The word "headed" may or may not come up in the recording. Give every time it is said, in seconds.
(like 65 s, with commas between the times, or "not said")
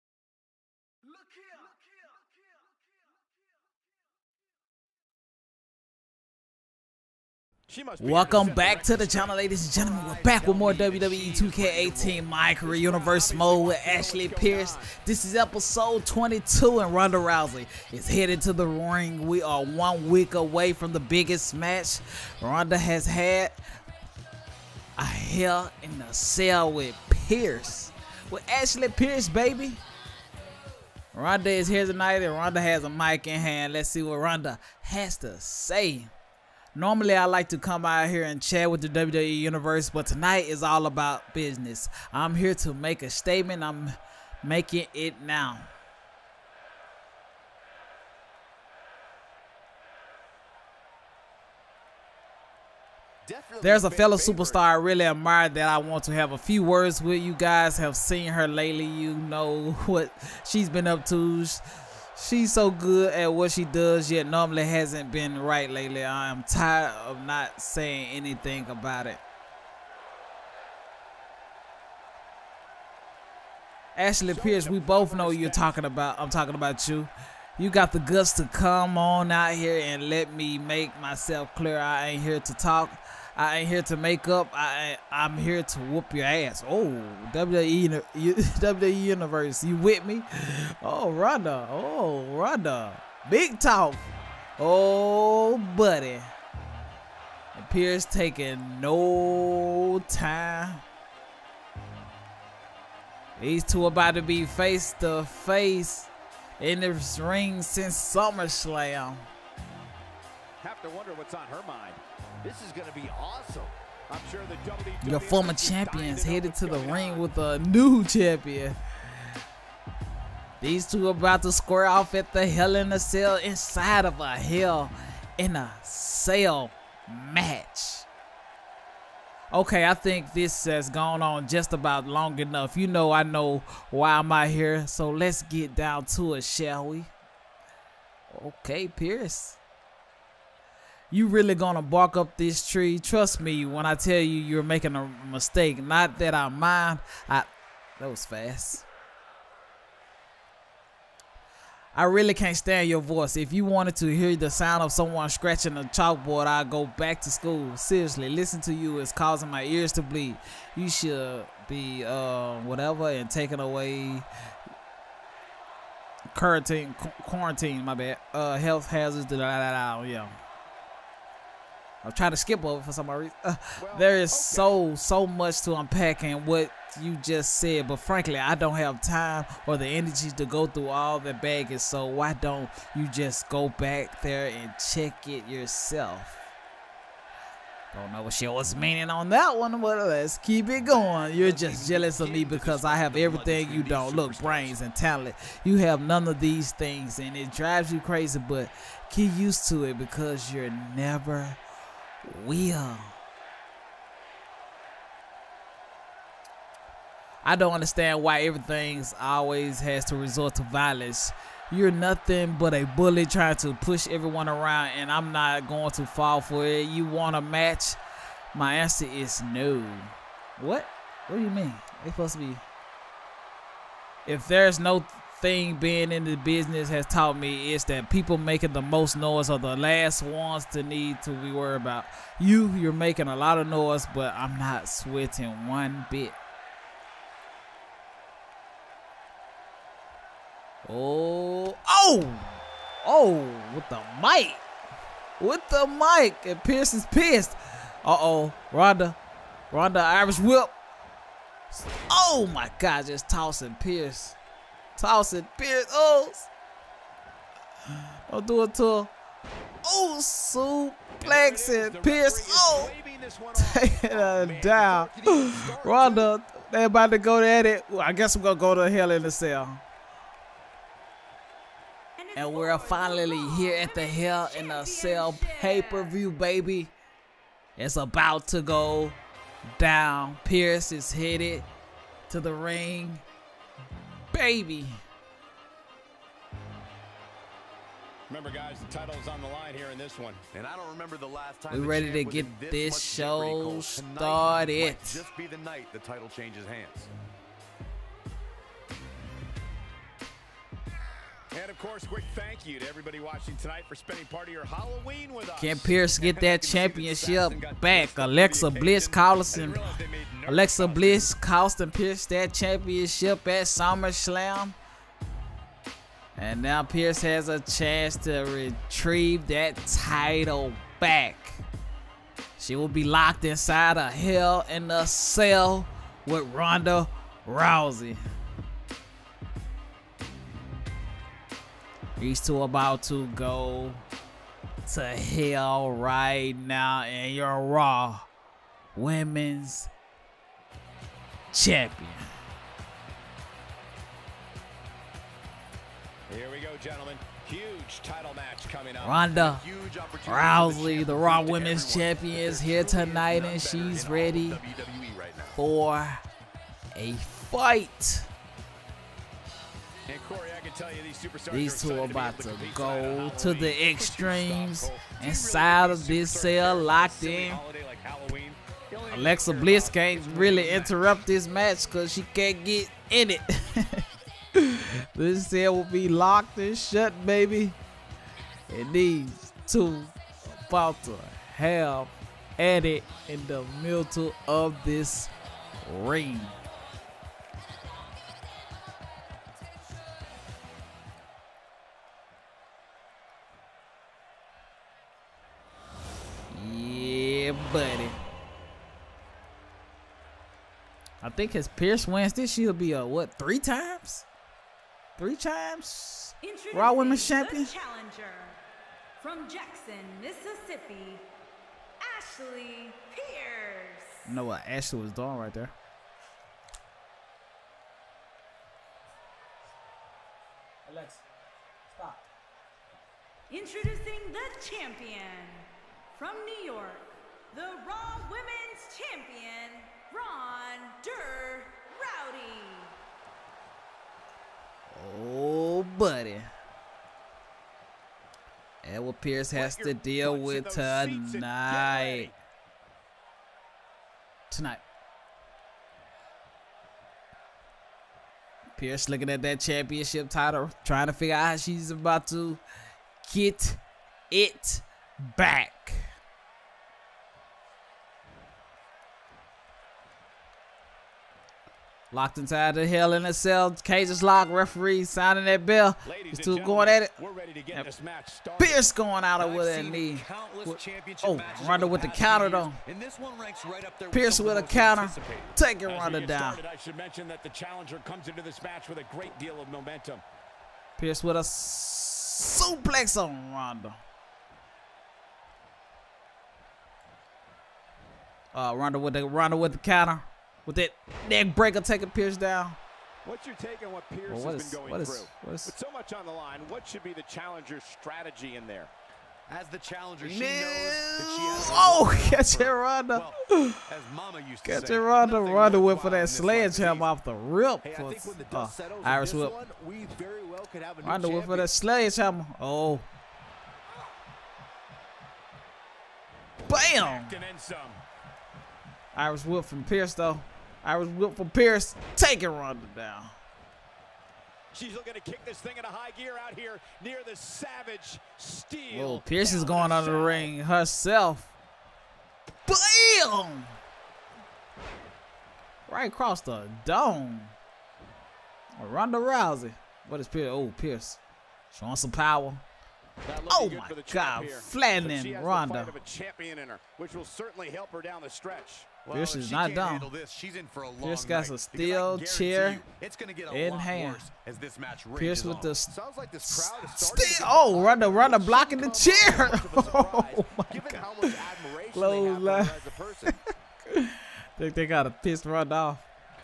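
18 s, 116 s, 281 s.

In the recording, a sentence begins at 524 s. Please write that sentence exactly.
She's looking to kick this thing into high gear out here near the Savage Steel.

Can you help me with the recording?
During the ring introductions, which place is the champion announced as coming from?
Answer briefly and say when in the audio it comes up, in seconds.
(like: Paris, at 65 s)
New York, at 426 s.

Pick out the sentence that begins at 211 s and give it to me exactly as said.
You're nothing but a bully trying to push everyone around, and I'm not going to fall for it.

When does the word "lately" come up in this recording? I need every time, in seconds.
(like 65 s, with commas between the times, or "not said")
58 s, 65 s.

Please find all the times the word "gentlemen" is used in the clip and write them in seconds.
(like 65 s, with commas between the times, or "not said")
9 s, 346 s.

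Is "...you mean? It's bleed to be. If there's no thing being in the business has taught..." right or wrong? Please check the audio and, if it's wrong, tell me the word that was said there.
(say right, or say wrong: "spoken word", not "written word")
wrong: "supposed", not "bleed".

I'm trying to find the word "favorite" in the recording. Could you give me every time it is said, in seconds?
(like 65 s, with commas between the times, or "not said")
54 s.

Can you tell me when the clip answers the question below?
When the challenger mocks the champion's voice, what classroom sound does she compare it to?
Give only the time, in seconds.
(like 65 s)
155 s.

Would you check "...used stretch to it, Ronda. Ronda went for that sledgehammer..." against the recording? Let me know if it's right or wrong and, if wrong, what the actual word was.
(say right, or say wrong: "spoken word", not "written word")
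wrong: "catch", not "stretch".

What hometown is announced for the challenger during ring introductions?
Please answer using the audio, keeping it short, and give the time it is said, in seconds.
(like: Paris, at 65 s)
Jackson, Mississippi, at 409 s.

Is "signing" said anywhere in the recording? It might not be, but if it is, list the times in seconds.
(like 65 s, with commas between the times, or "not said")
465 s.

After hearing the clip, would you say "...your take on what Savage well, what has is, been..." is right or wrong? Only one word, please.
wrong.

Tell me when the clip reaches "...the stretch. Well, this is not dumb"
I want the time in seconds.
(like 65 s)
548 s.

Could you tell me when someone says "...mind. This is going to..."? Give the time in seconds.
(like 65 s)
111 s.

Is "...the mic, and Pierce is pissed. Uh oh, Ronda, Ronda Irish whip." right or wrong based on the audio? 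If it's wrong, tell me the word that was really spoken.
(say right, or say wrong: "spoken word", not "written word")
right.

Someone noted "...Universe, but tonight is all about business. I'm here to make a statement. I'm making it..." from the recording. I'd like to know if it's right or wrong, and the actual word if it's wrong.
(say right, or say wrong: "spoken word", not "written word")
right.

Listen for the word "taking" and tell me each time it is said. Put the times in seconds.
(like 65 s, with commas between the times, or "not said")
98 s, 163 s, 263 s, 475 s, 491 s, 522 s.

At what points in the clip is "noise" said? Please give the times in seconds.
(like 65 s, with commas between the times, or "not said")
229 s, 233 s.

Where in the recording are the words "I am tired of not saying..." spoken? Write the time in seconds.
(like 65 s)
66 s.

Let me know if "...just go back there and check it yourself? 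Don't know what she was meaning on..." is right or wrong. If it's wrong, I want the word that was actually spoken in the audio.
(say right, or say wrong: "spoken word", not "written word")
right.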